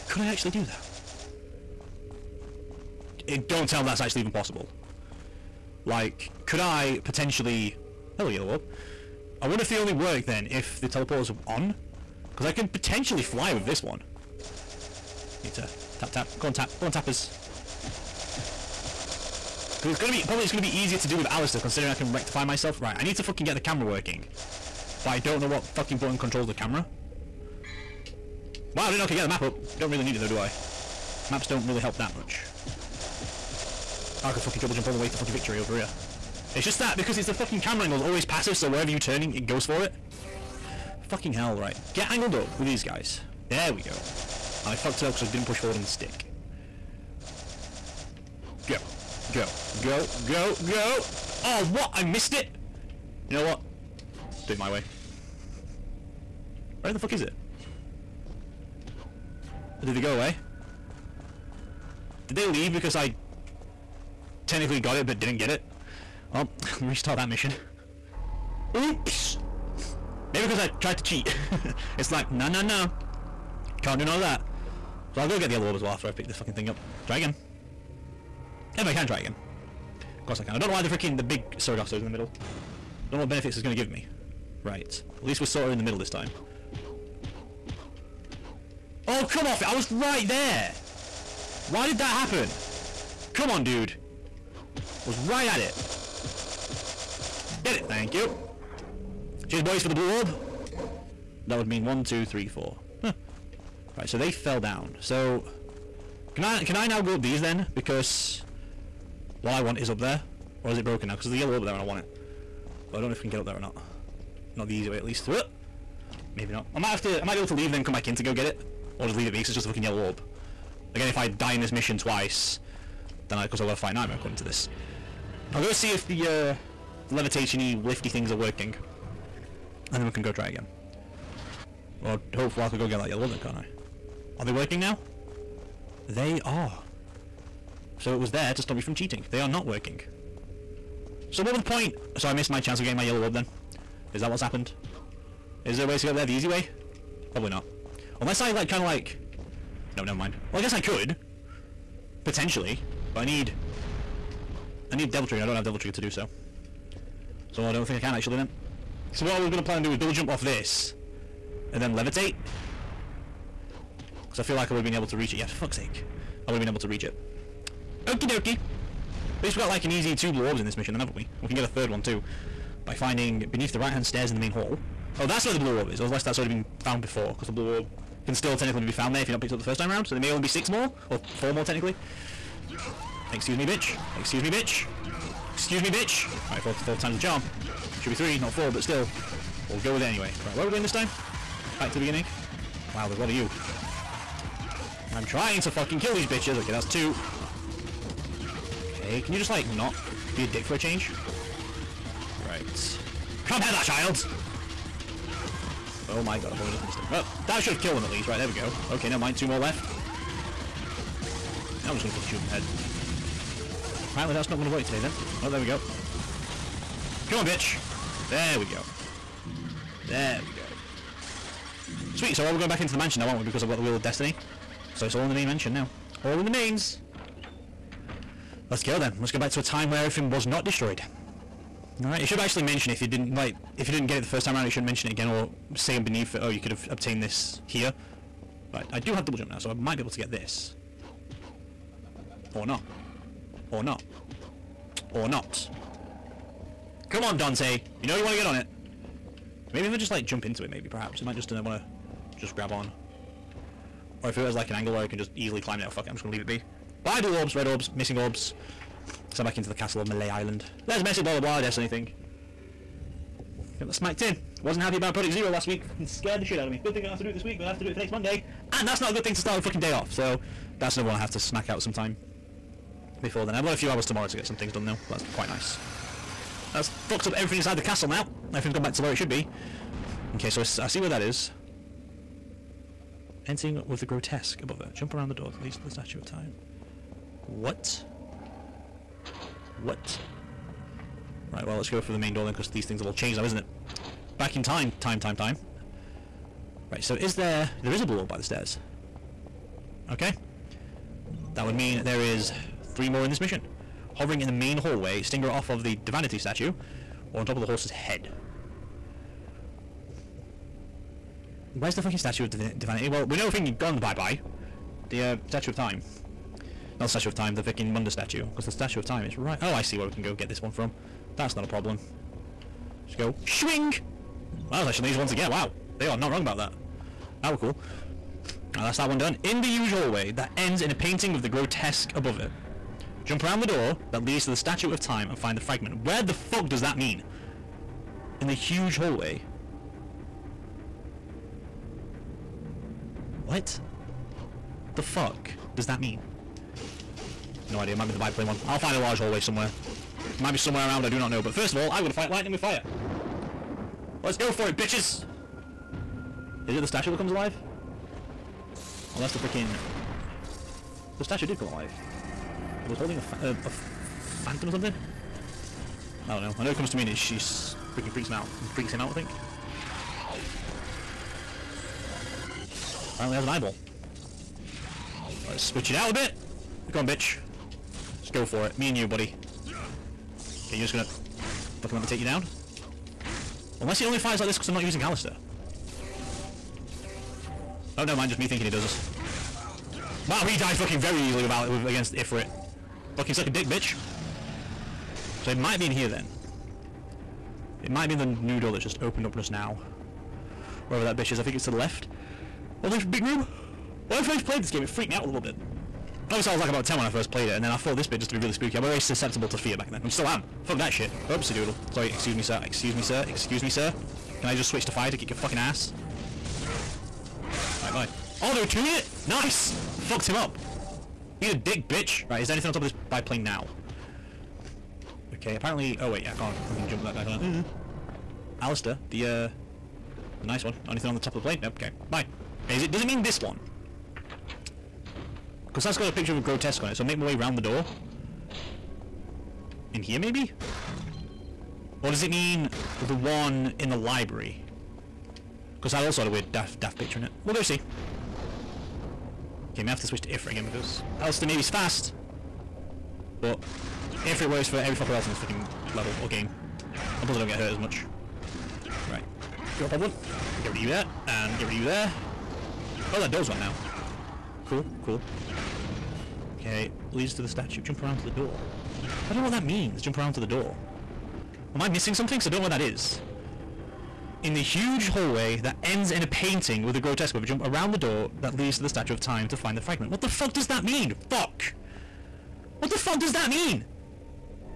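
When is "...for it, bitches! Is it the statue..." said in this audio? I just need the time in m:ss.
5:54.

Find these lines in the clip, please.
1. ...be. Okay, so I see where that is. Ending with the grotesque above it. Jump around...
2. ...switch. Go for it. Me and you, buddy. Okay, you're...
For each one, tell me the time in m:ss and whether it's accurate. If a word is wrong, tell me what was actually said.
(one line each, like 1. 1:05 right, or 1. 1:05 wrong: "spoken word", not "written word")
1. 4:39 right
2. 6:17 wrong: "bitch", not "switch".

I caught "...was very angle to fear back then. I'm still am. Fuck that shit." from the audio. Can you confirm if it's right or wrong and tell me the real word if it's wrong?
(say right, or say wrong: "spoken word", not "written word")
wrong: "susceptible", not "angle".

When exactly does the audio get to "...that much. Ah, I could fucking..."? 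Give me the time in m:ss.
0:31.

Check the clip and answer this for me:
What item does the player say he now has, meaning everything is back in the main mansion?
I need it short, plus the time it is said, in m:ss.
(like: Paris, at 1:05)
Wheel of Destiny, at 3:43.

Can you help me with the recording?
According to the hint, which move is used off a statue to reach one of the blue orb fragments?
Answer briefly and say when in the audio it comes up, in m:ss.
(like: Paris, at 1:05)
Stinger, at 5:05.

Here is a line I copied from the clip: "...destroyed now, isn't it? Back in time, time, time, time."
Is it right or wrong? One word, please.
wrong.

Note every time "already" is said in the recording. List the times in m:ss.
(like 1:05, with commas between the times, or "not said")
2:56, 3:26.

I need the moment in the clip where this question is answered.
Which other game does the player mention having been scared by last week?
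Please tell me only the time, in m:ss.
4:25.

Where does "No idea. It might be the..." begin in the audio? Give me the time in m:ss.
5:47.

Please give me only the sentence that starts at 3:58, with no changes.
But I do have double jump now, so I might be able to get this.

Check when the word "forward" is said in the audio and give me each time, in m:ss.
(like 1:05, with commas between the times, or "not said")
0:45.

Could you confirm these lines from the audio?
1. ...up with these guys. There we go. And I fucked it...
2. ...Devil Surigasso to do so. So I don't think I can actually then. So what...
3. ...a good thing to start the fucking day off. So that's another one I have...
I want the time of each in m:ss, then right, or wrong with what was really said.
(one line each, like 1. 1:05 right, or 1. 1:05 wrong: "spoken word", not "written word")
1. 0:42 right
2. 2:35 wrong: "Trigger", not "Surigasso"
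3. 4:29 right.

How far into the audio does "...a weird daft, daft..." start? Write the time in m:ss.
7:26.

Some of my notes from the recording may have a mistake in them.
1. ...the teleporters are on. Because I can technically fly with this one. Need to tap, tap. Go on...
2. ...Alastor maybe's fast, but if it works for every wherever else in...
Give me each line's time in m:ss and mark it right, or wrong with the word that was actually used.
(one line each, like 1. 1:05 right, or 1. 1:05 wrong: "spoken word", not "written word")
1. 0:10 wrong: "potentially", not "technically"
2. 7:31 wrong: "fucker", not "wherever".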